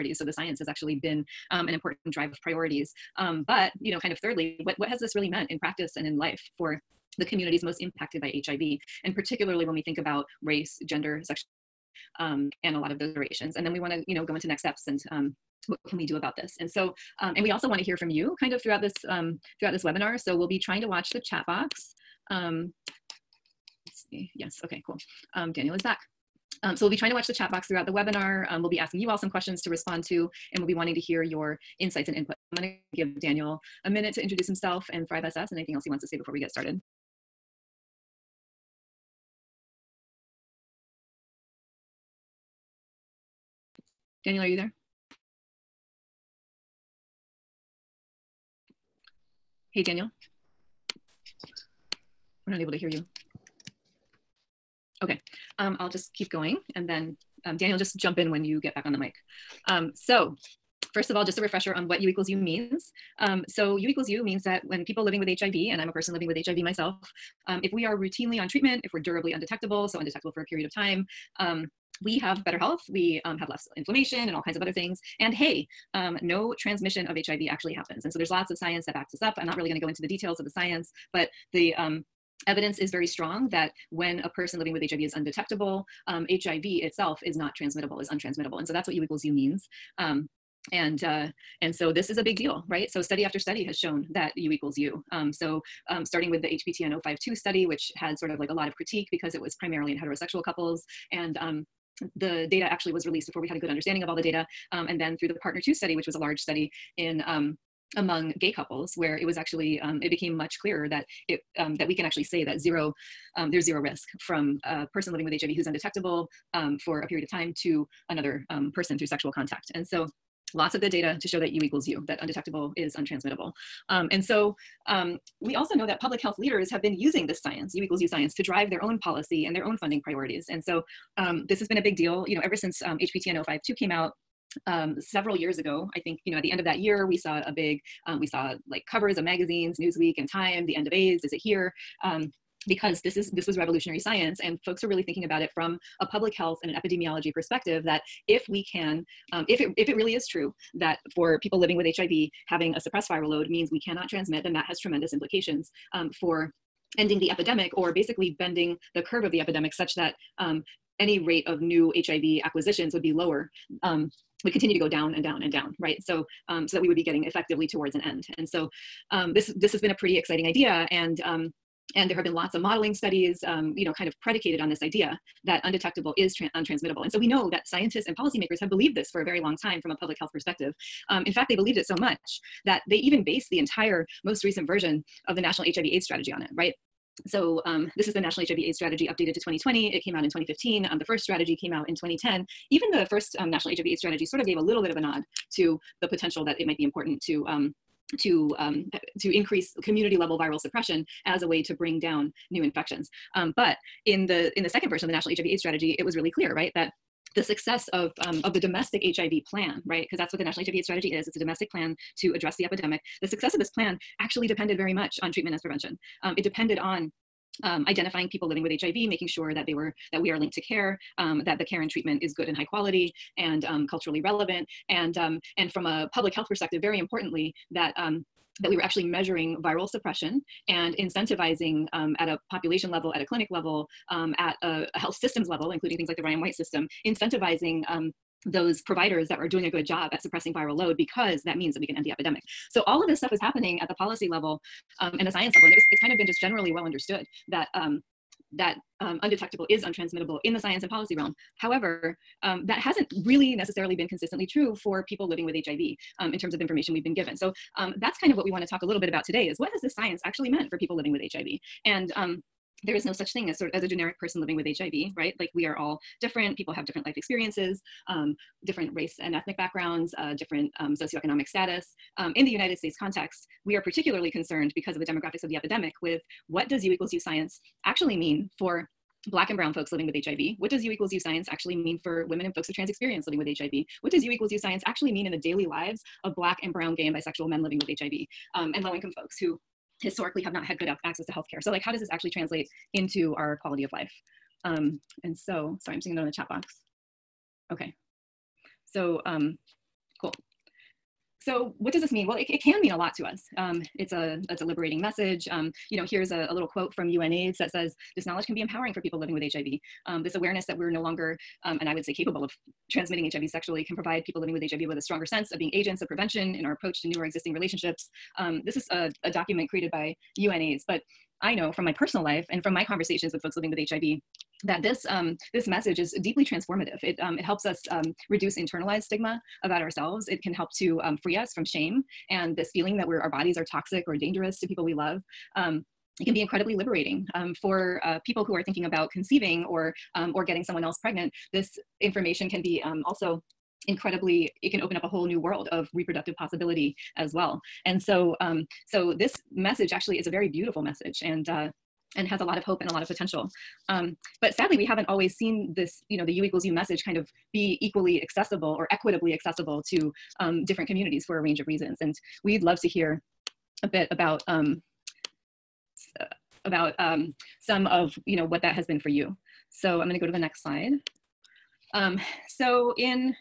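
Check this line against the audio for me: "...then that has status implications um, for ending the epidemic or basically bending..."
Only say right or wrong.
wrong.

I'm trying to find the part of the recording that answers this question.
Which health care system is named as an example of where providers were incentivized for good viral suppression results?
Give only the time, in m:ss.
3:56.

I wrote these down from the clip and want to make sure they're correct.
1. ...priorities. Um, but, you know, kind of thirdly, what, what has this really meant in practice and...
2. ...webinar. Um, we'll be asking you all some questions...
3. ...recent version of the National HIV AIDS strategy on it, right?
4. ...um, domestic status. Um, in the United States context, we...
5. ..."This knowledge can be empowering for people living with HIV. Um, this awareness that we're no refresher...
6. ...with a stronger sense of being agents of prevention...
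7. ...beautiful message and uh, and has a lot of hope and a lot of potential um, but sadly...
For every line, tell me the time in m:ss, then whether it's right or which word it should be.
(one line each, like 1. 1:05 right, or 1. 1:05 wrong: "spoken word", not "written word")
1. 0:02 right
2. 0:27 right
3. 3:04 right
4. 4:30 wrong: "socioeconomic", not "domestic"
5. 5:08 wrong: "longer", not "refresher"
6. 5:14 right
7. 5:50 right.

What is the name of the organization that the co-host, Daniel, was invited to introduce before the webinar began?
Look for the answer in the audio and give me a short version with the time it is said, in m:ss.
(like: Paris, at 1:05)
Thrive SS, at 0:35.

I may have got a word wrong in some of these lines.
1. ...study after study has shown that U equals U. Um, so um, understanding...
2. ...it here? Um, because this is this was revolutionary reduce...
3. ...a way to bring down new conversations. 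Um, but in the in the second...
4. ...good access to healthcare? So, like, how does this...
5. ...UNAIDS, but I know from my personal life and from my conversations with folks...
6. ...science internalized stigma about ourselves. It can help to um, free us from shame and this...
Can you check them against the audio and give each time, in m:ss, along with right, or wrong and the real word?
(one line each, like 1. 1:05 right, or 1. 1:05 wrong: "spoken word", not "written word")
1. 1:33 wrong: "starting", not "understanding"
2. 2:21 wrong: "science", not "reduce"
3. 3:21 wrong: "infections", not "conversations"
4. 4:50 right
5. 5:20 right
6. 5:28 wrong: "reduce", not "science".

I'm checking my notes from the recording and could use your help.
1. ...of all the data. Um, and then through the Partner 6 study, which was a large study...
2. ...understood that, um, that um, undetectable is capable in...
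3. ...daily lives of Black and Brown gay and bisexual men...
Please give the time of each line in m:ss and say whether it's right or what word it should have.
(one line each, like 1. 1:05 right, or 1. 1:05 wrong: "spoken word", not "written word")
1. 1:44 wrong: "2", not "6"
2. 4:06 wrong: "untransmittable", not "capable"
3. 4:45 right.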